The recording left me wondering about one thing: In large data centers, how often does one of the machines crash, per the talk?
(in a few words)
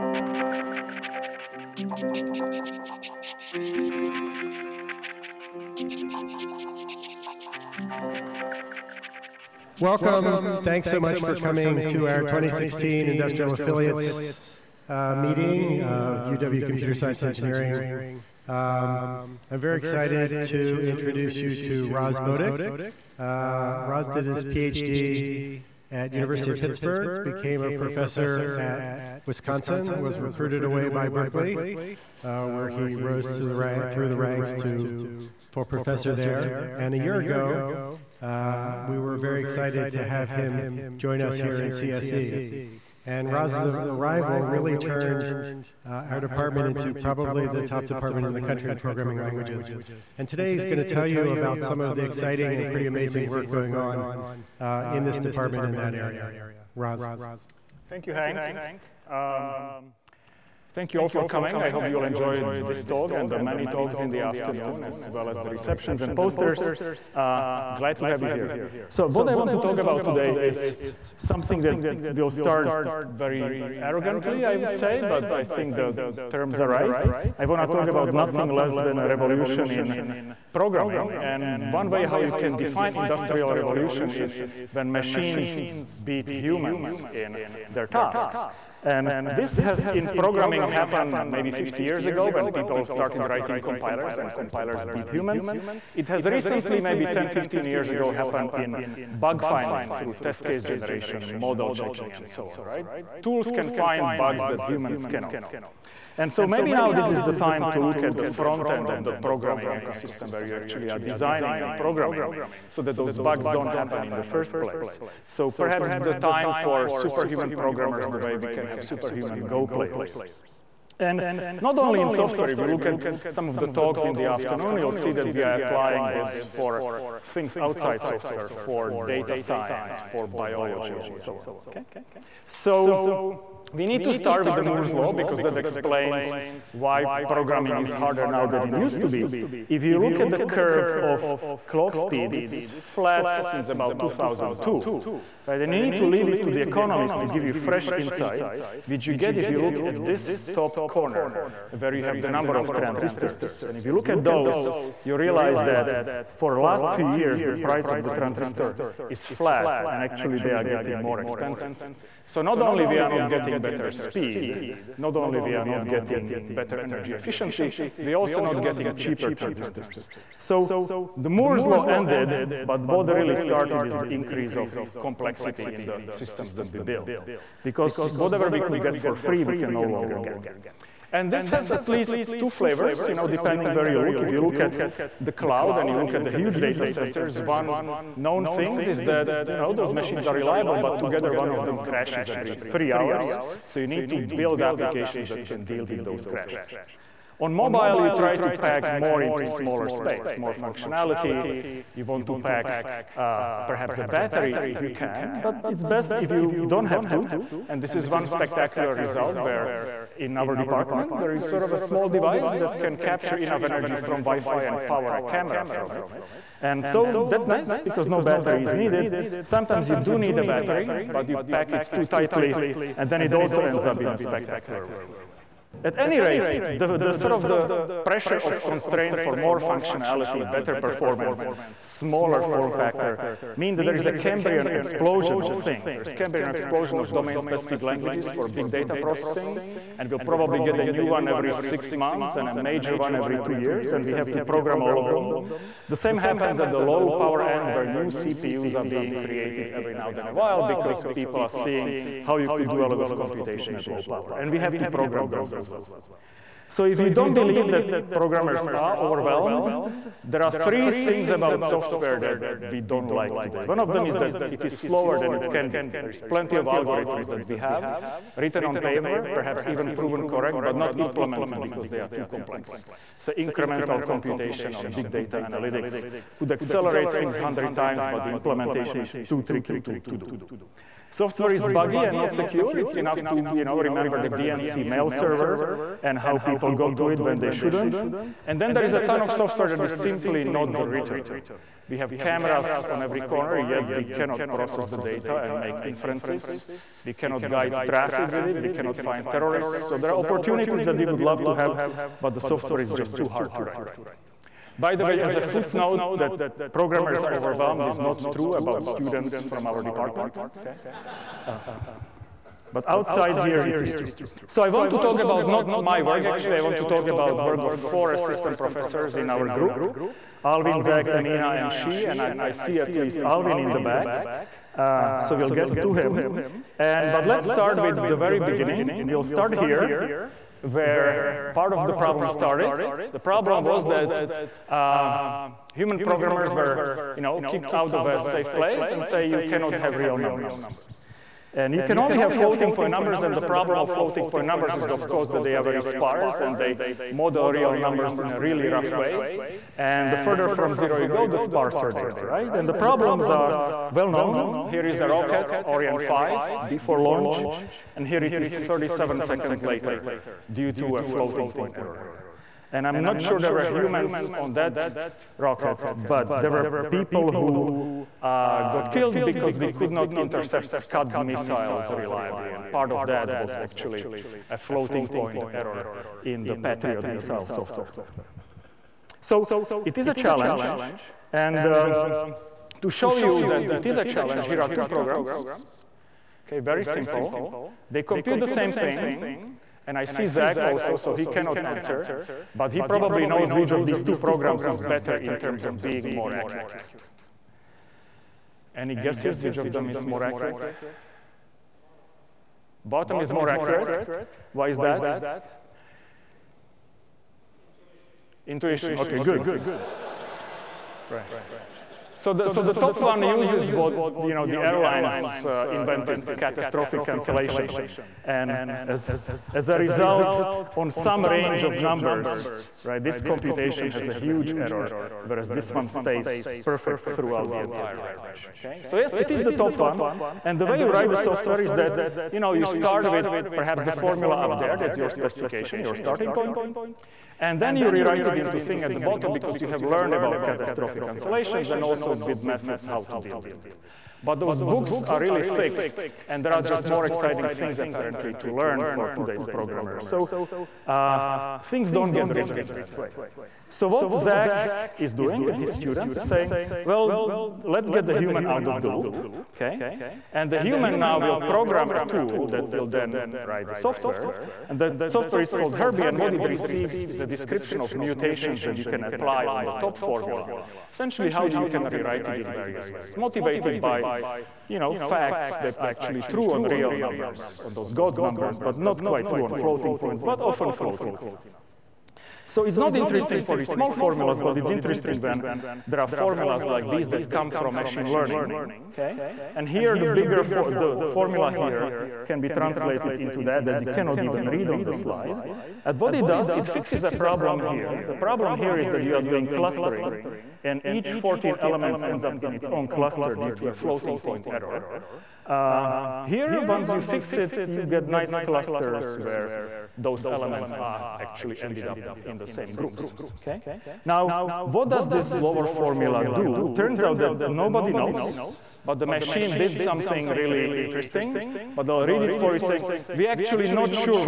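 every three hours.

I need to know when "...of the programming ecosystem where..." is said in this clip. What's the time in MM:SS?
01:48.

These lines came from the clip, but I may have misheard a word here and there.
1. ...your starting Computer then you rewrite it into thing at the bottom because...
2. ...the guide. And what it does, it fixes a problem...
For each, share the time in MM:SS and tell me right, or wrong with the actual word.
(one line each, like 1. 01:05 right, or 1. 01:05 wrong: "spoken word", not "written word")
1. 07:15 wrong: "And", not "Computer"
2. 08:14 wrong: "slide", not "guide".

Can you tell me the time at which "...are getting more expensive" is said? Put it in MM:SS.
02:40.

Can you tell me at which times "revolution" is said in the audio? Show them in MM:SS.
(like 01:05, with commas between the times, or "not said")
01:19, 01:23.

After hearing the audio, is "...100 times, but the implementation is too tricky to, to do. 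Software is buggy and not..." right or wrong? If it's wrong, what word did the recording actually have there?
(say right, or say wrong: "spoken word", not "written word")
right.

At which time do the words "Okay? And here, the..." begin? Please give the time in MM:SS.
08:08.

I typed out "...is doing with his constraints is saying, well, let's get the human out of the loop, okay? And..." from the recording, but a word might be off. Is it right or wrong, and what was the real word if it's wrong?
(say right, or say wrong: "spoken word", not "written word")
wrong: "students", not "constraints".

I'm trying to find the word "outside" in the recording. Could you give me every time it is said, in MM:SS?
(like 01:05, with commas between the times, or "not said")
02:07, 05:12.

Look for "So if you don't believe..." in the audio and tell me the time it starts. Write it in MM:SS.
04:16.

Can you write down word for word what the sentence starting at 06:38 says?
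Any guesses which of them is more accurate?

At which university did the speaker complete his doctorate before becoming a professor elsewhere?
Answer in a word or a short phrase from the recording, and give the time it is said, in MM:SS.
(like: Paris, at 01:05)
University of Pittsburgh, at 00:26.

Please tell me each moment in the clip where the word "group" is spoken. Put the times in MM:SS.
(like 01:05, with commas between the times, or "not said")
05:19, 08:32.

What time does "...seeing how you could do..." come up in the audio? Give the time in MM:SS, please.
04:11.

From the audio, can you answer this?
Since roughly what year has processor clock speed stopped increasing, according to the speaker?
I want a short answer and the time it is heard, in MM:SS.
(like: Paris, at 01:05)
2002, at 02:23.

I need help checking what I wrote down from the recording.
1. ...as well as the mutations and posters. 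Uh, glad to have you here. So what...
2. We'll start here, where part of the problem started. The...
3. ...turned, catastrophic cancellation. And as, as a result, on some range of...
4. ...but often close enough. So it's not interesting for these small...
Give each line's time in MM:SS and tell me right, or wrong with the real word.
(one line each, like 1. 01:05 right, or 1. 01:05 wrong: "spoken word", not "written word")
1. 01:04 wrong: "receptions", not "mutations"
2. 05:29 right
3. 06:55 wrong: "invented", not "turned"
4. 08:00 right.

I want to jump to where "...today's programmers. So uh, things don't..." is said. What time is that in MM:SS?
07:29.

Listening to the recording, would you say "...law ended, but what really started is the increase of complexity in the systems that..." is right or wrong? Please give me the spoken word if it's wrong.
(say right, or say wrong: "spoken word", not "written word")
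right.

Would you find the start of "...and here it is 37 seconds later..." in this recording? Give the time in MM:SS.
05:57.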